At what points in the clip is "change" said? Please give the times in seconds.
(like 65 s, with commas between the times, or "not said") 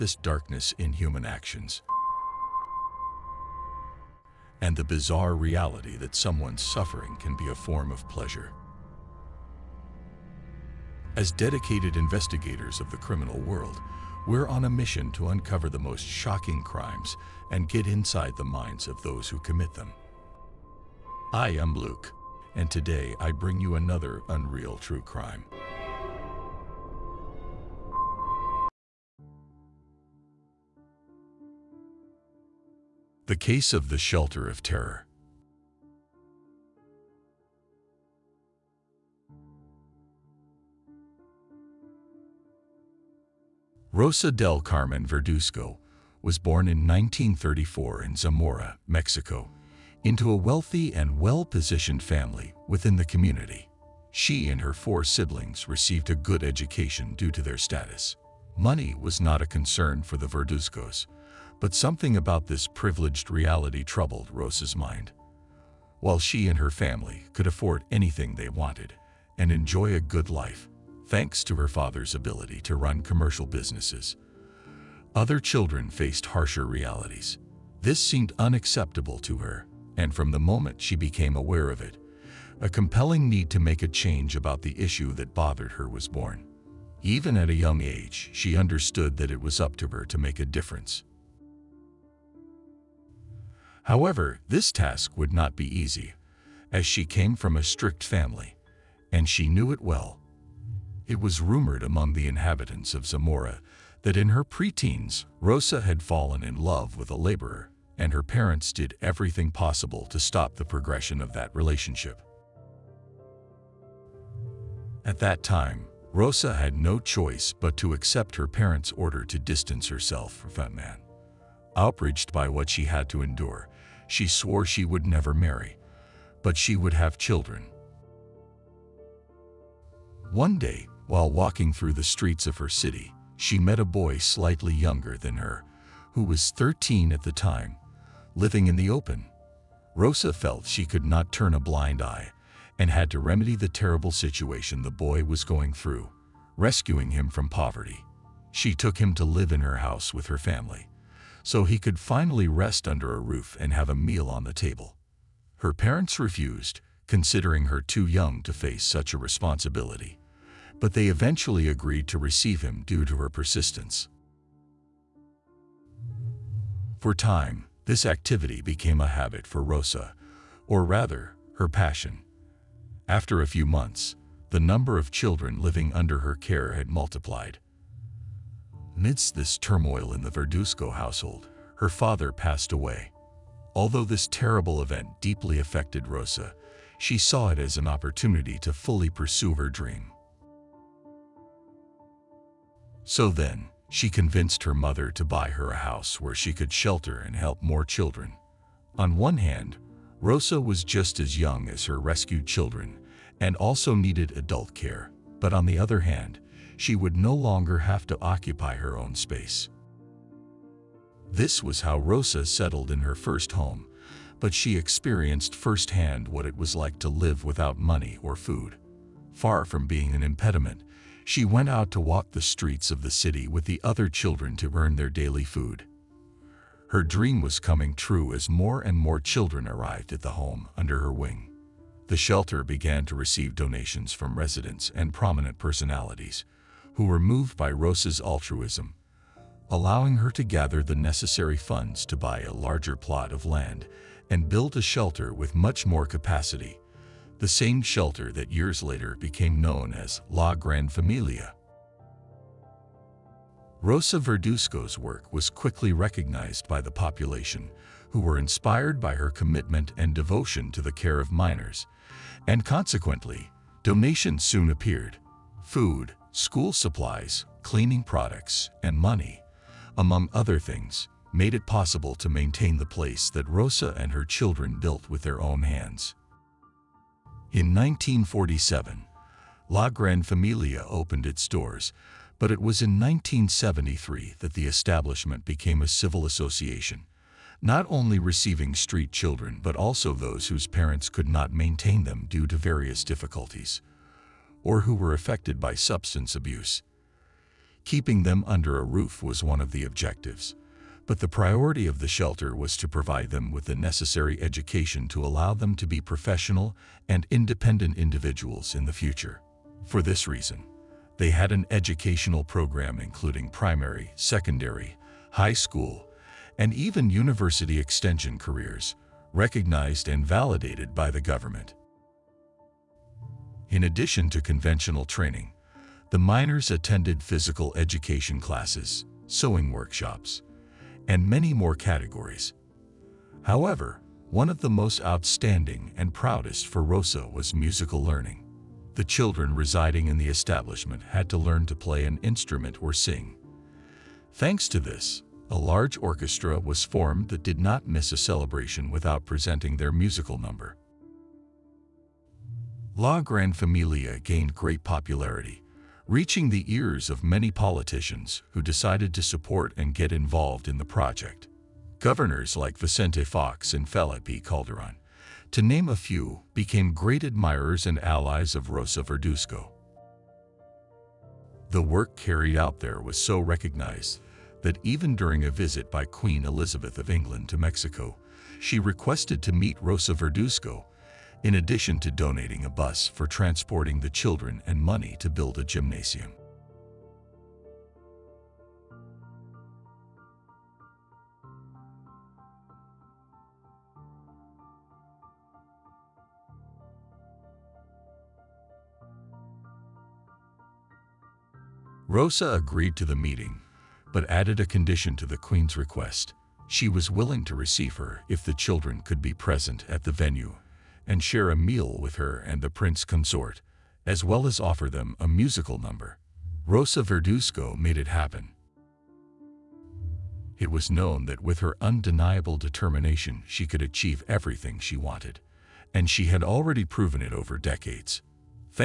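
83 s.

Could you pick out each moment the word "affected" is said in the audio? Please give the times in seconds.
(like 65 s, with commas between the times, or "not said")
185 s, 295 s.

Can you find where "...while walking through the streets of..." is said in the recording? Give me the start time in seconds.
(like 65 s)
131 s.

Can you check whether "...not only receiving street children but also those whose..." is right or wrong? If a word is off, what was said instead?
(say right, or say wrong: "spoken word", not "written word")
right.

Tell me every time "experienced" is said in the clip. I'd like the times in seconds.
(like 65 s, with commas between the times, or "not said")
214 s.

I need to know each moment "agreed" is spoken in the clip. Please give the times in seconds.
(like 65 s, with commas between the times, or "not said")
161 s, 402 s.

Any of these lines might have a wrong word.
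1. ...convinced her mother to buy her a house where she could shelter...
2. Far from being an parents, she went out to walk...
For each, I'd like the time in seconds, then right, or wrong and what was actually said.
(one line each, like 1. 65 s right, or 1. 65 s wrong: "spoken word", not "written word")
1. 194 s right
2. 219 s wrong: "impediment", not "parents".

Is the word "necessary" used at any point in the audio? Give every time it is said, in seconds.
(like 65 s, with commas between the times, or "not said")
240 s, 303 s.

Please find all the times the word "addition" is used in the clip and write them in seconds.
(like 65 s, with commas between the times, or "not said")
323 s, 381 s.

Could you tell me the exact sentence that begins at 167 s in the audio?
For time, this activity became a habit for Rosa, or rather, her passion.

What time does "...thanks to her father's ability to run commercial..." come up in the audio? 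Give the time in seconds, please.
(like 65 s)
71 s.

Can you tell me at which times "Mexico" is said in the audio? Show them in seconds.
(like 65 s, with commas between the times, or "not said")
48 s, 377 s.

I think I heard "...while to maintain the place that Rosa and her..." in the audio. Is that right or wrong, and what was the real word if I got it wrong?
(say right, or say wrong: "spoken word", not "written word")
wrong: "possible", not "while".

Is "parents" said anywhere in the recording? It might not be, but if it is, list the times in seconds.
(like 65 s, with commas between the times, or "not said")
108 s, 118 s, 155 s, 290 s.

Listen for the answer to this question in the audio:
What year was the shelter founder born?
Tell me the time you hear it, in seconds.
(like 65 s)
46 s.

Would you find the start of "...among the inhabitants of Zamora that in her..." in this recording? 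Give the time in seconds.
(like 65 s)
101 s.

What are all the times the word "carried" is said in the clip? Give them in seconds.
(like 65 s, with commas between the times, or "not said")
372 s.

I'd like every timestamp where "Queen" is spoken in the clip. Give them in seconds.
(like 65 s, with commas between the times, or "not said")
376 s, 405 s.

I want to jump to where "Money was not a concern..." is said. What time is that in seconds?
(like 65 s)
58 s.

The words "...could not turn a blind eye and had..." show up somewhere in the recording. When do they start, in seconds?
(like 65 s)
140 s.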